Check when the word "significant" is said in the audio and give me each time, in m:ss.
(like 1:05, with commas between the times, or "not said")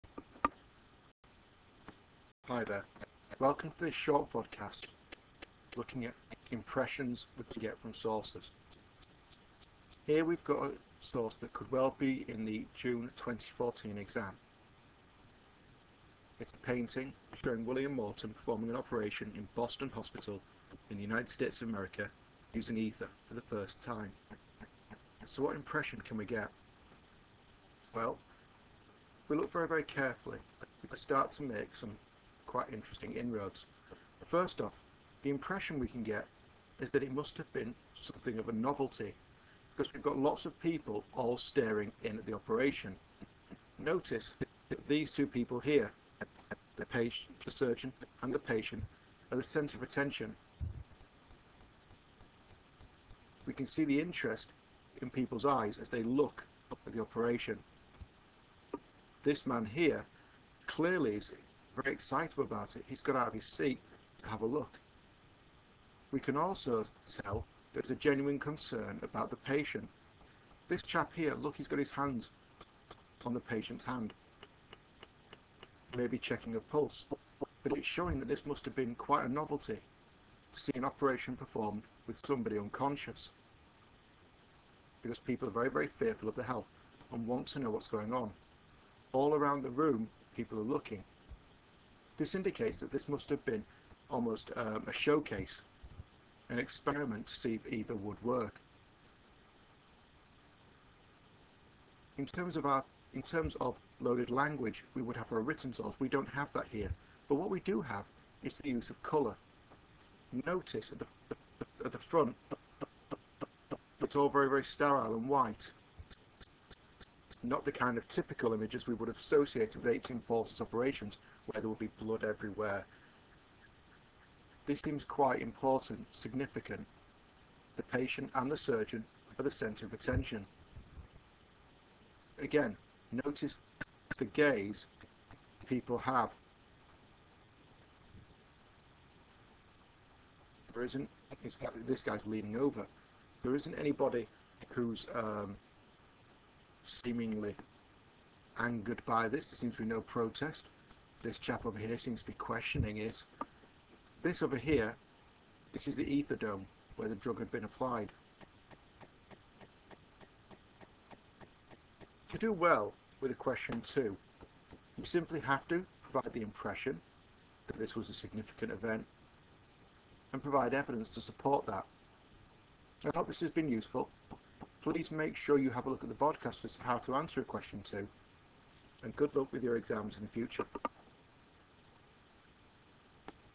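2:06, 2:48.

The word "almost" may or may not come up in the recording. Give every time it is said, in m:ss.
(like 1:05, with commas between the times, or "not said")
1:34.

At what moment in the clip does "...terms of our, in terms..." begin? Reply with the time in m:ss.
1:42.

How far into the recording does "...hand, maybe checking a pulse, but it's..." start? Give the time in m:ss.
1:13.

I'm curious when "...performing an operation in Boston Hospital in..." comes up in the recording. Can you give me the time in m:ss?
0:18.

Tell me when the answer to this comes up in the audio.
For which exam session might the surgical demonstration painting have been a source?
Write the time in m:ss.
0:12.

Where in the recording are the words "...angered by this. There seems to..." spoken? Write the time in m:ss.
2:28.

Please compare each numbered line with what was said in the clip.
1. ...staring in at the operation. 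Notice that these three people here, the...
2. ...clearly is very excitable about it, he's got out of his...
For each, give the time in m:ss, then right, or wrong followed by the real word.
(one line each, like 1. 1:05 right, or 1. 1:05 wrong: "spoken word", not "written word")
1. 0:41 wrong: "two", not "three"
2. 1:00 right.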